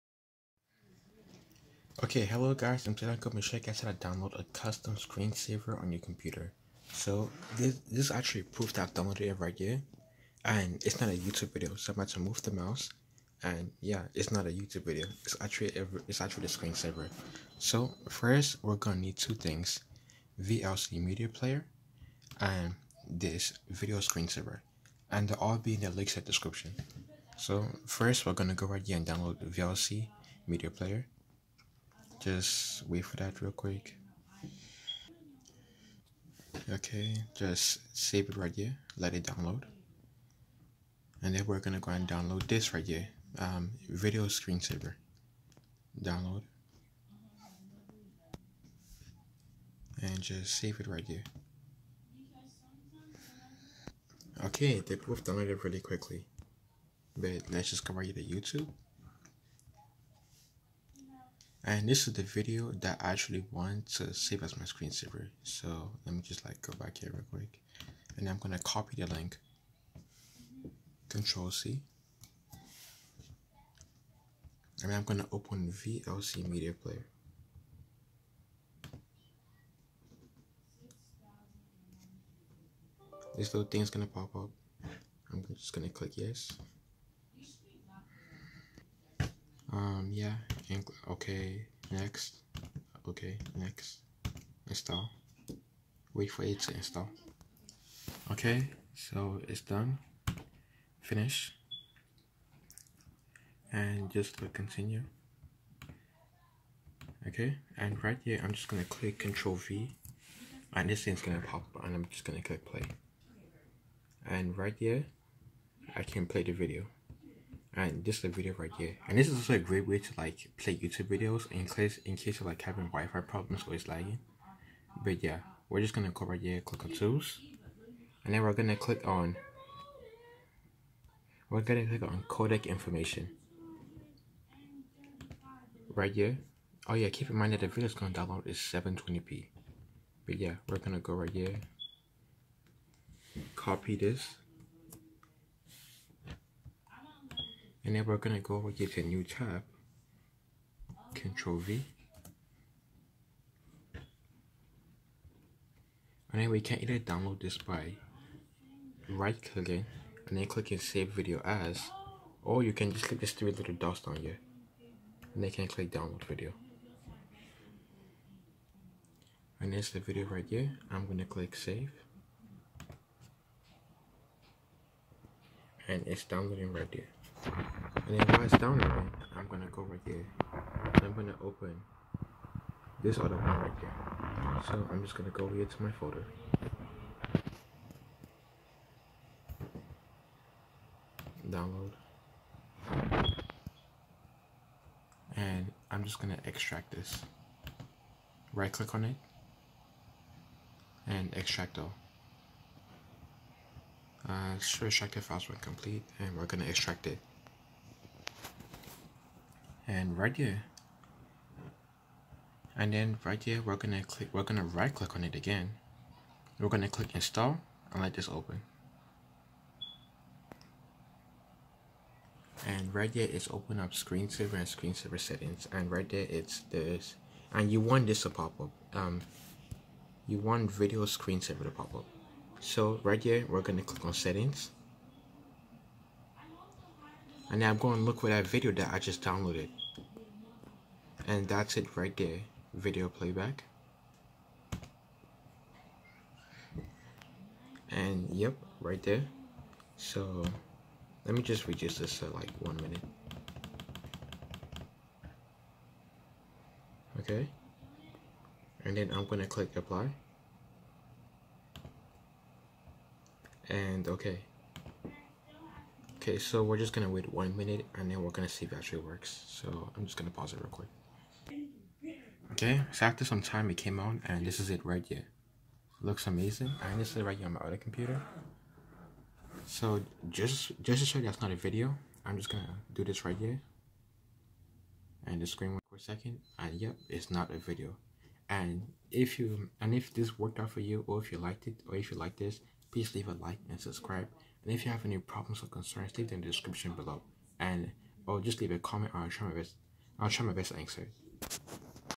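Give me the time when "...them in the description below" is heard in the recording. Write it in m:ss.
4:56.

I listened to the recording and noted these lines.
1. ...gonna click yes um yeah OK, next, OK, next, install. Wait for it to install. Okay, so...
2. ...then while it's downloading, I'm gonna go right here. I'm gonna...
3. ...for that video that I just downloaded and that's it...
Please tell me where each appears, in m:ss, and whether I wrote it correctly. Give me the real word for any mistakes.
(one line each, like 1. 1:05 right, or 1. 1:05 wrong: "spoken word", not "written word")
1. 1:25 right
2. 2:58 right
3. 3:58 right.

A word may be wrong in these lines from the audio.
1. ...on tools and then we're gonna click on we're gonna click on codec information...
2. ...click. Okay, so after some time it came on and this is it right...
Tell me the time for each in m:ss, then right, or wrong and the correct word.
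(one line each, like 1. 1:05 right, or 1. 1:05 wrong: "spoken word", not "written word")
1. 2:06 right
2. 4:30 wrong: "quick", not "click".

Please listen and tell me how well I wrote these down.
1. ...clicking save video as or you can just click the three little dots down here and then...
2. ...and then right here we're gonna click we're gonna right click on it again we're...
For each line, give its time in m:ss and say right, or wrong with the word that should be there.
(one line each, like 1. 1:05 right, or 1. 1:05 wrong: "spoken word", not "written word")
1. 2:40 right
2. 3:32 right.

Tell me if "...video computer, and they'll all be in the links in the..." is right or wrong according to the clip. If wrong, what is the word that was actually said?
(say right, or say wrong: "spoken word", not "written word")
wrong: "screensaver", not "computer".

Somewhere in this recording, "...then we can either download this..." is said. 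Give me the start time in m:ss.
2:36.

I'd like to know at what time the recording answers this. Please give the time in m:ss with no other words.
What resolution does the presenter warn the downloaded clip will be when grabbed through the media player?
2:18.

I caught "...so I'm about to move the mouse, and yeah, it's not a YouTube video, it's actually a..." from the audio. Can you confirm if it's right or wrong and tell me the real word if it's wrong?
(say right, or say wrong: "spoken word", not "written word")
right.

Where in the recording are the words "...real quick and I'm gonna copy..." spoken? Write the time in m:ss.
1:07.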